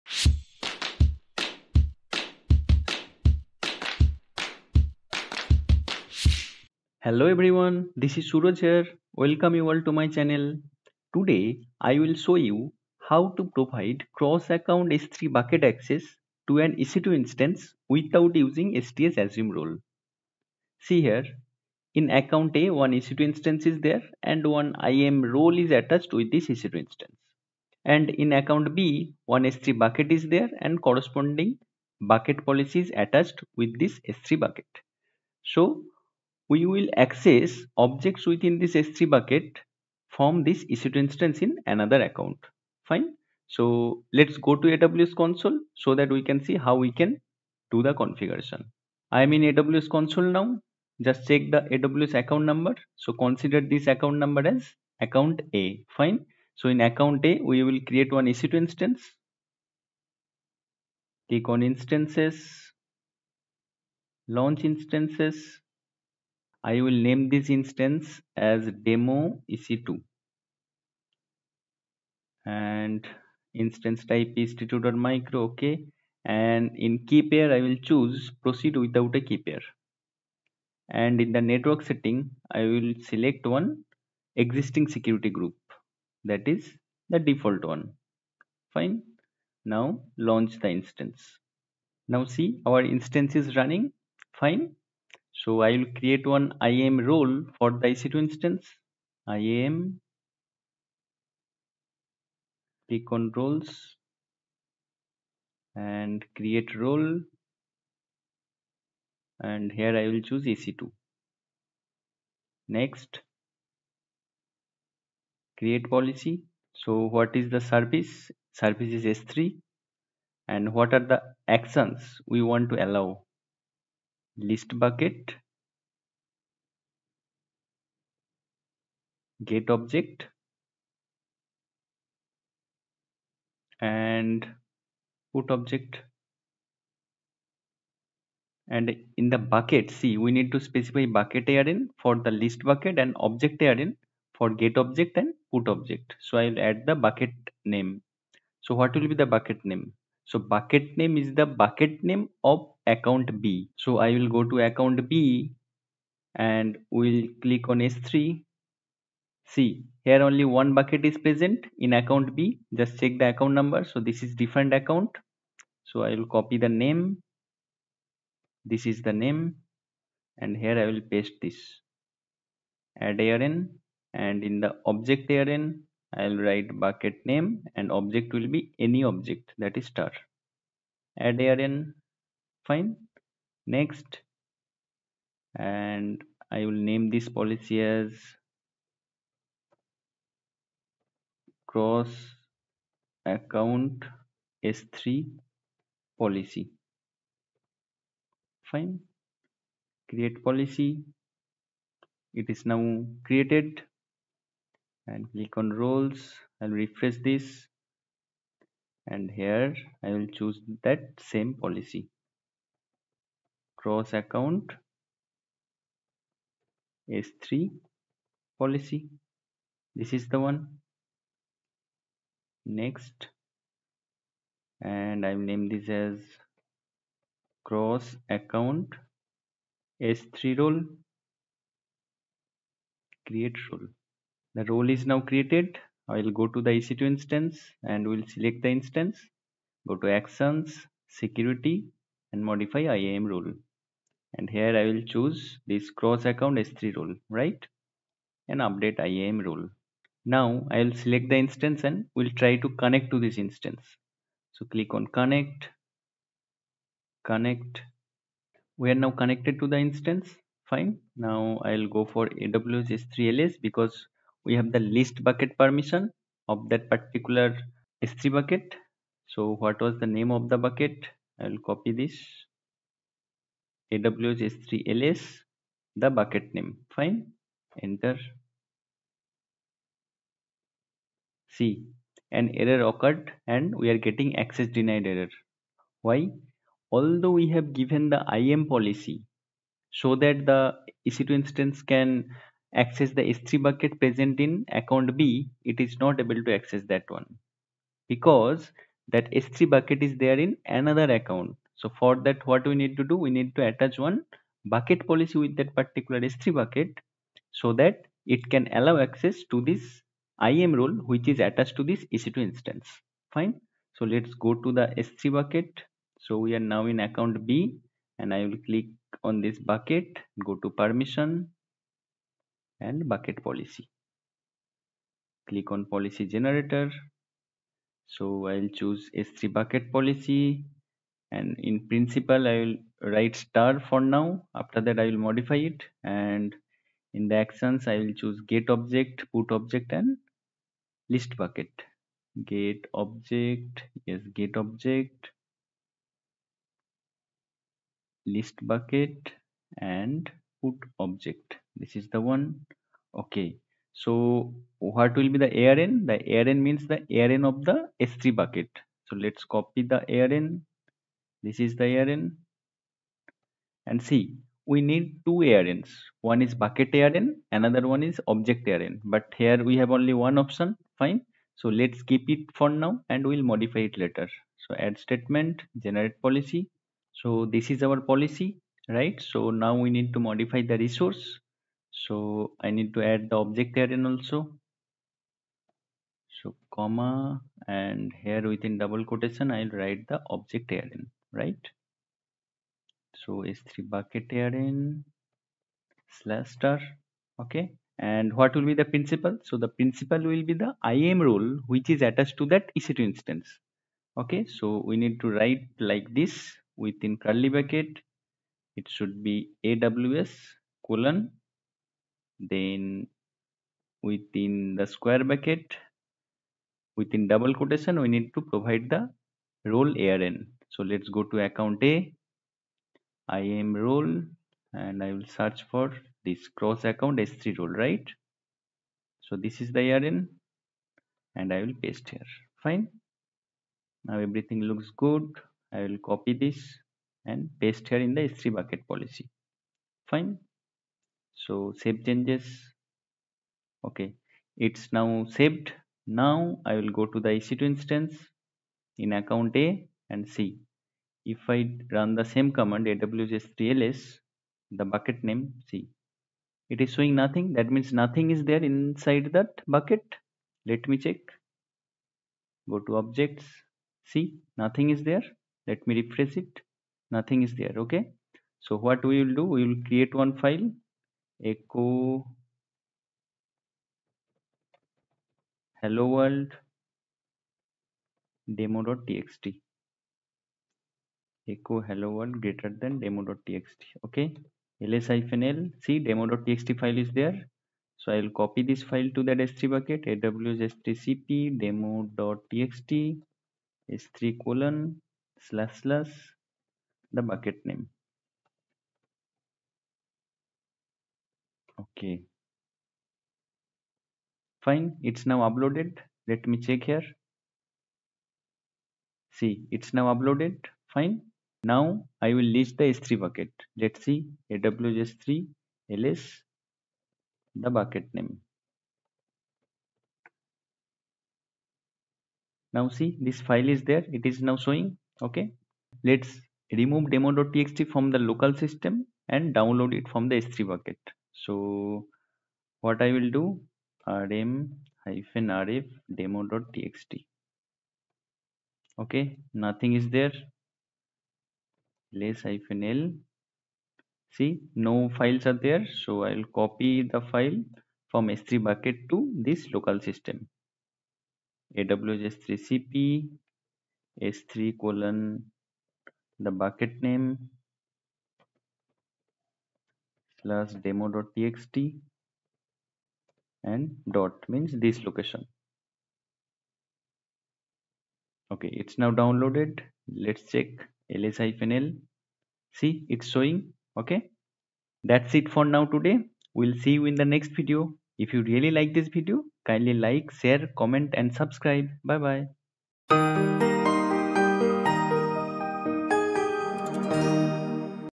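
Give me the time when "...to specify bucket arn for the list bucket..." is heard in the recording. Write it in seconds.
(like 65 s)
140 s.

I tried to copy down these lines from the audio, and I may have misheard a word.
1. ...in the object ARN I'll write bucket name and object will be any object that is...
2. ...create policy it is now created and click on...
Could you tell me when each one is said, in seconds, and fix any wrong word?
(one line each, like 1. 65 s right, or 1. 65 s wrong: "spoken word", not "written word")
1. 174 s right
2. 200 s right.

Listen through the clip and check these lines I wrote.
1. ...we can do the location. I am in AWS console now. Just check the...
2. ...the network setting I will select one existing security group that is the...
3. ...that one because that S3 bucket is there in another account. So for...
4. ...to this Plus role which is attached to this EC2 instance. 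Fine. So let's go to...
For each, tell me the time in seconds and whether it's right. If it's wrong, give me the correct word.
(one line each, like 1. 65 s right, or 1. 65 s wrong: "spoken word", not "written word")
1. 46 s wrong: "configuration", not "location"
2. 81 s right
3. 296 s right
4. 309 s wrong: "IAM", not "Plus".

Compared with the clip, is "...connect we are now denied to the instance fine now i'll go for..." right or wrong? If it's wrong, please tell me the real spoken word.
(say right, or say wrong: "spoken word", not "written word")
wrong: "connected", not "denied".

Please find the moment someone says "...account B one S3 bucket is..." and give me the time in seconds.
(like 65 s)
28 s.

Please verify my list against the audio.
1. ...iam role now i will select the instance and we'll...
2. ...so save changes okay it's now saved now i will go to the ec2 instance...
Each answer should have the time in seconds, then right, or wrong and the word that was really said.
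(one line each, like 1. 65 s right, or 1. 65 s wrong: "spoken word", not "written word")
1. 249 s right
2. 441 s right.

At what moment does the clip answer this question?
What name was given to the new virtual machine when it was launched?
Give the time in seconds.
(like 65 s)
68 s.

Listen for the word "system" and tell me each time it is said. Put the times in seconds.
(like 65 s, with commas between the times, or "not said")
528 s, 550 s.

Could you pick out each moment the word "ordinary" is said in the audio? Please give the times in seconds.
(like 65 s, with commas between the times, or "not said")
not said.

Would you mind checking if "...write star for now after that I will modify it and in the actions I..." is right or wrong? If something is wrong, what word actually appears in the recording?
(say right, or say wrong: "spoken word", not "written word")
right.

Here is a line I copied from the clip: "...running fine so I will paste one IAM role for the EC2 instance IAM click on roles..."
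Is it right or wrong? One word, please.
wrong.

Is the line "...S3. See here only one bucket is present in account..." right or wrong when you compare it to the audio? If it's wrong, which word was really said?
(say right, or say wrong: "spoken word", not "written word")
right.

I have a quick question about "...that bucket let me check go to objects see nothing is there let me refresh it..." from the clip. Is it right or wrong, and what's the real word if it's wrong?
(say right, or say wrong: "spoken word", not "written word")
right.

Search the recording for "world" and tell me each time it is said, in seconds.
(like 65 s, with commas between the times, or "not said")
476 s, 482 s.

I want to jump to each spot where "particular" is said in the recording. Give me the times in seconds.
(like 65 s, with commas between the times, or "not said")
266 s, 305 s.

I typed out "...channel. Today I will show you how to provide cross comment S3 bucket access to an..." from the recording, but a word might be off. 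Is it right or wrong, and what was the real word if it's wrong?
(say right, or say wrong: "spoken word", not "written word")
wrong: "account", not "comment".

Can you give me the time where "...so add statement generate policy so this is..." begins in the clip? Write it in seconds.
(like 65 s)
374 s.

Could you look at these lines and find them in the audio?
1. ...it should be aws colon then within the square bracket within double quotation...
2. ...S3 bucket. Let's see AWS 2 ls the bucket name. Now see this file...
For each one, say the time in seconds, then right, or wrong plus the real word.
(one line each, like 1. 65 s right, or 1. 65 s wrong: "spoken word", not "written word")
1. 408 s right
2. 512 s wrong: "3", not "2".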